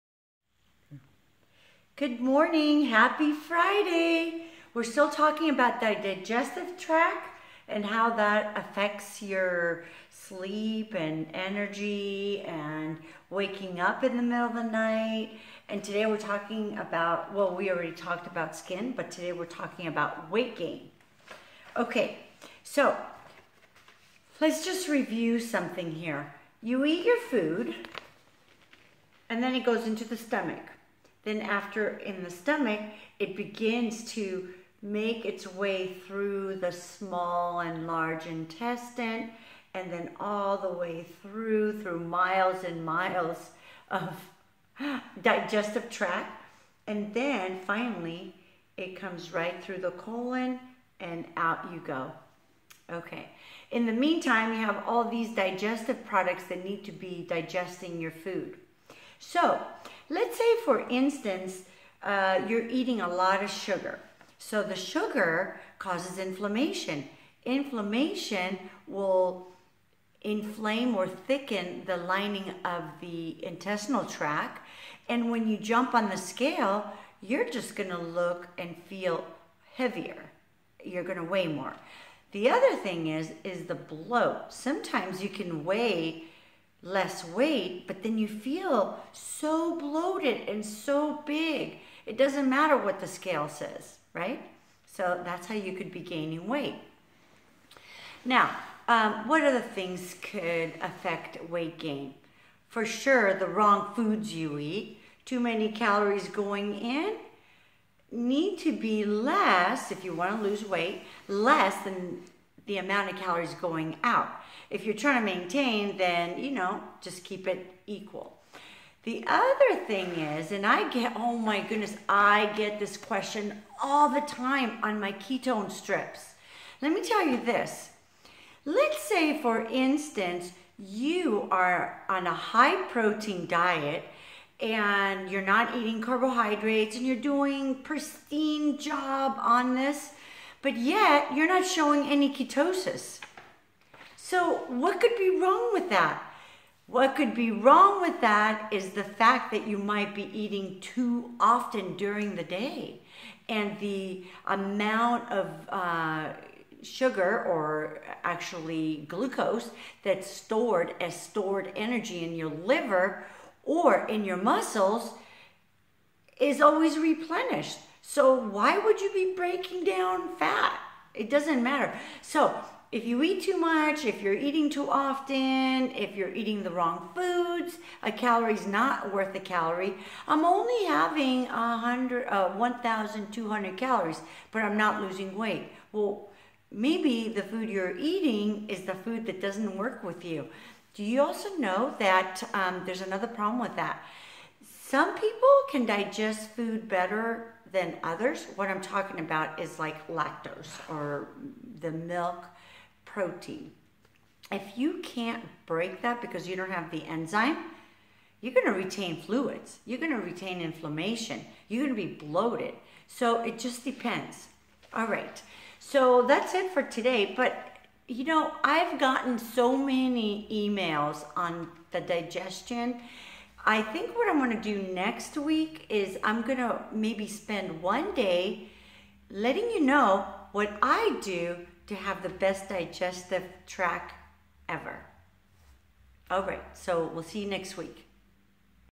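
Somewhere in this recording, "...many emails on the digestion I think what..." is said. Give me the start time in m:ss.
3:39.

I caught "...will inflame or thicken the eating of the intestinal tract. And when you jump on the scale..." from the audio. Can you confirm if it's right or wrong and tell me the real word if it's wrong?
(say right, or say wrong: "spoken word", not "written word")
wrong: "lining", not "eating".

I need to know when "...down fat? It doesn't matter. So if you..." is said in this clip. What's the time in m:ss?
2:49.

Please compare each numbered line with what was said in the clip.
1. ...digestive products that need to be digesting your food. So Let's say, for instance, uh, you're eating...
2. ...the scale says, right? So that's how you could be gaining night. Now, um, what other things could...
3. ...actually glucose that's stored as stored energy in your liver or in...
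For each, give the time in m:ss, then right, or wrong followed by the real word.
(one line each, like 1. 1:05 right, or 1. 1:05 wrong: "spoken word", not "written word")
1. 0:55 right
2. 1:32 wrong: "weight", not "night"
3. 2:38 right.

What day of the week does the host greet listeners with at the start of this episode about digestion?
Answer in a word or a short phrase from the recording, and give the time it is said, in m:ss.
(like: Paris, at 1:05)
Friday, at 0:03.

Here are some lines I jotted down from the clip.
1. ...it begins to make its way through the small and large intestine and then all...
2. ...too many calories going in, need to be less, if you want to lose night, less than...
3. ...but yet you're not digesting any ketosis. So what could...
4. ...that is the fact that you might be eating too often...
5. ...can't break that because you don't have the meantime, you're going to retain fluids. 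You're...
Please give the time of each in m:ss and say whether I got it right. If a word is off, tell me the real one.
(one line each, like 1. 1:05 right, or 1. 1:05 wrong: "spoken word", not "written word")
1. 0:33 right
2. 1:45 wrong: "weight", not "night"
3. 2:20 wrong: "showing", not "digesting"
4. 2:28 right
5. 3:25 wrong: "enzyme", not "meantime".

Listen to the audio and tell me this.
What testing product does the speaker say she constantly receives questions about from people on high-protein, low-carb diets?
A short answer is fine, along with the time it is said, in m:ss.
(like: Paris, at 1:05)
ketone strips, at 2:05.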